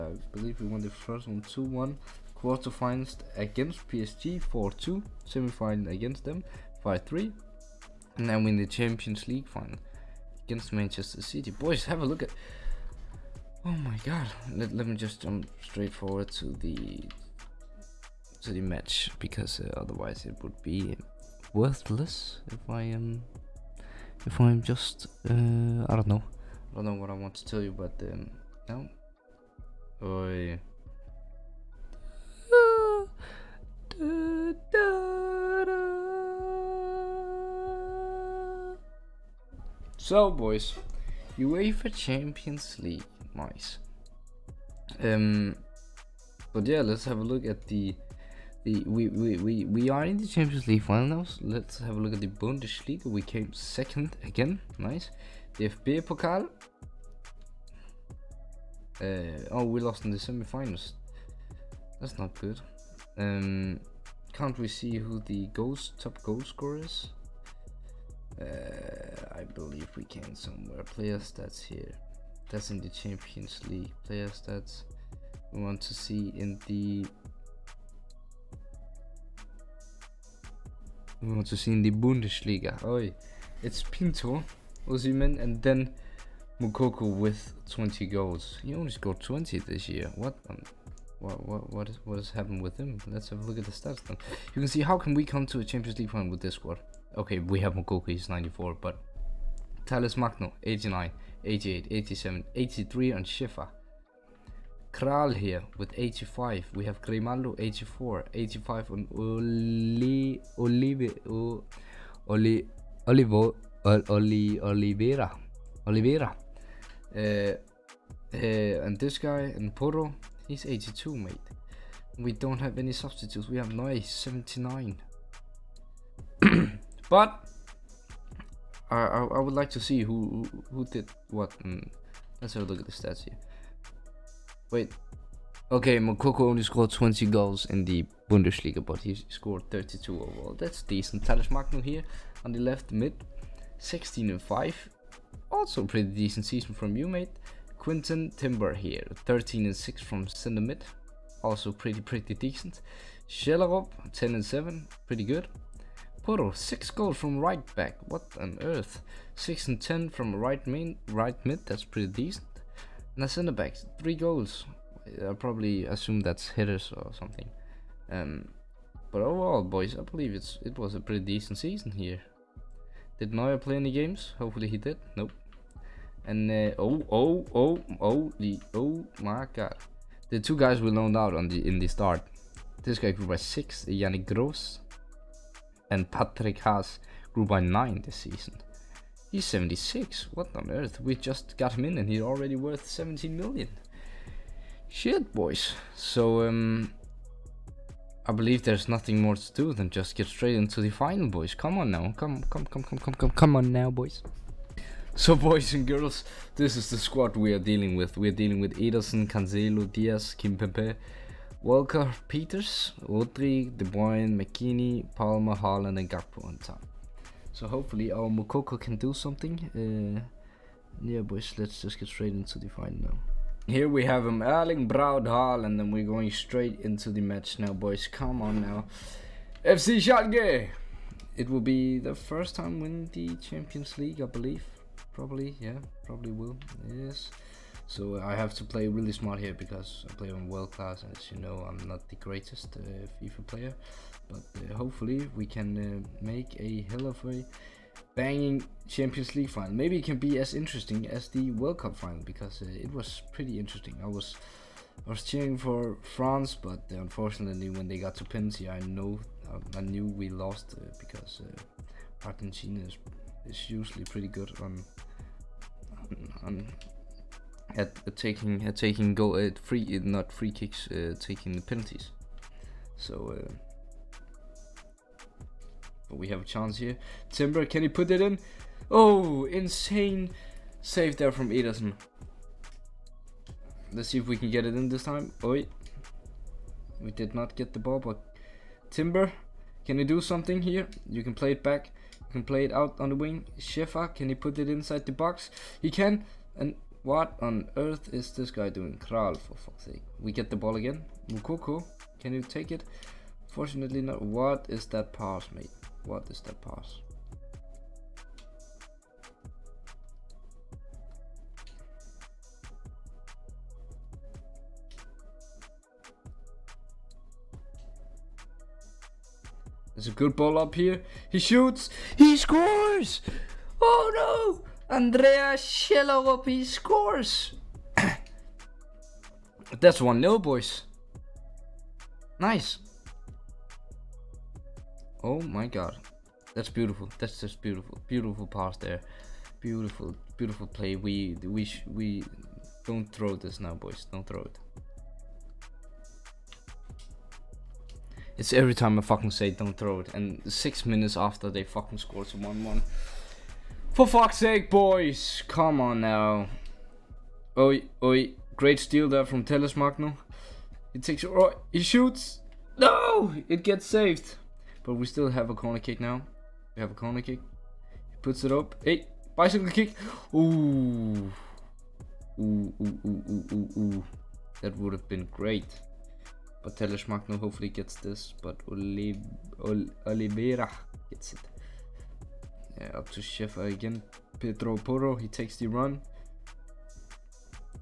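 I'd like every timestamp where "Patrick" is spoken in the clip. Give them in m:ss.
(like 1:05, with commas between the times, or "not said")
3:06.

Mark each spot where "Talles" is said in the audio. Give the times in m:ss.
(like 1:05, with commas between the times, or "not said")
1:39, 2:21, 5:59, 6:16.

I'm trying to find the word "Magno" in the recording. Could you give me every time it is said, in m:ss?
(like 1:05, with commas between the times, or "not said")
1:40, 2:21, 5:59, 6:17.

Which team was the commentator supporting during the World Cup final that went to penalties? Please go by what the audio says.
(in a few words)
France.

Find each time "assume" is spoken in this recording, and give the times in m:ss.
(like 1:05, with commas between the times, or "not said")
2:45.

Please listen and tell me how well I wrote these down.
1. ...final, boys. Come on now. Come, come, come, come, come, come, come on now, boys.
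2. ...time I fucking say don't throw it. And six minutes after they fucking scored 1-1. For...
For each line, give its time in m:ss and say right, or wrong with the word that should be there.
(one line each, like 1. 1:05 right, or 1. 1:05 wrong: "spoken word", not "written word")
1. 3:20 right
2. 5:48 right.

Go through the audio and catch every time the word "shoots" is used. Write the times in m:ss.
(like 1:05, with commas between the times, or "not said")
5:21, 6:01.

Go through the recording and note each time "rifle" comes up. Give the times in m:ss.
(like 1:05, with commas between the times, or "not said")
not said.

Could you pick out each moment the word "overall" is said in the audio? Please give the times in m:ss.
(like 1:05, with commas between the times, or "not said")
2:20, 2:49.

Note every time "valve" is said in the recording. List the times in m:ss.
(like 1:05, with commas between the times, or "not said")
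not said.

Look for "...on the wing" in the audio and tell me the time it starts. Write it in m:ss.
4:53.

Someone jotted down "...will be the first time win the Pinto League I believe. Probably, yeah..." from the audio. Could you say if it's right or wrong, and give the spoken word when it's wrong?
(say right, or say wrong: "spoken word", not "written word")
wrong: "Champions", not "Pinto".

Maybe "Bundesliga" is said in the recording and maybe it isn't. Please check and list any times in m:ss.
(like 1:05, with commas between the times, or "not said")
0:52, 1:21, 2:18.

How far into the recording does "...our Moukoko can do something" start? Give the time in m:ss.
3:38.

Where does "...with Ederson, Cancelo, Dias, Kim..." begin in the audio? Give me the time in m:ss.
3:28.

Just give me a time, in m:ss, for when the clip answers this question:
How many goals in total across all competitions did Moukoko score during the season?
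2:19.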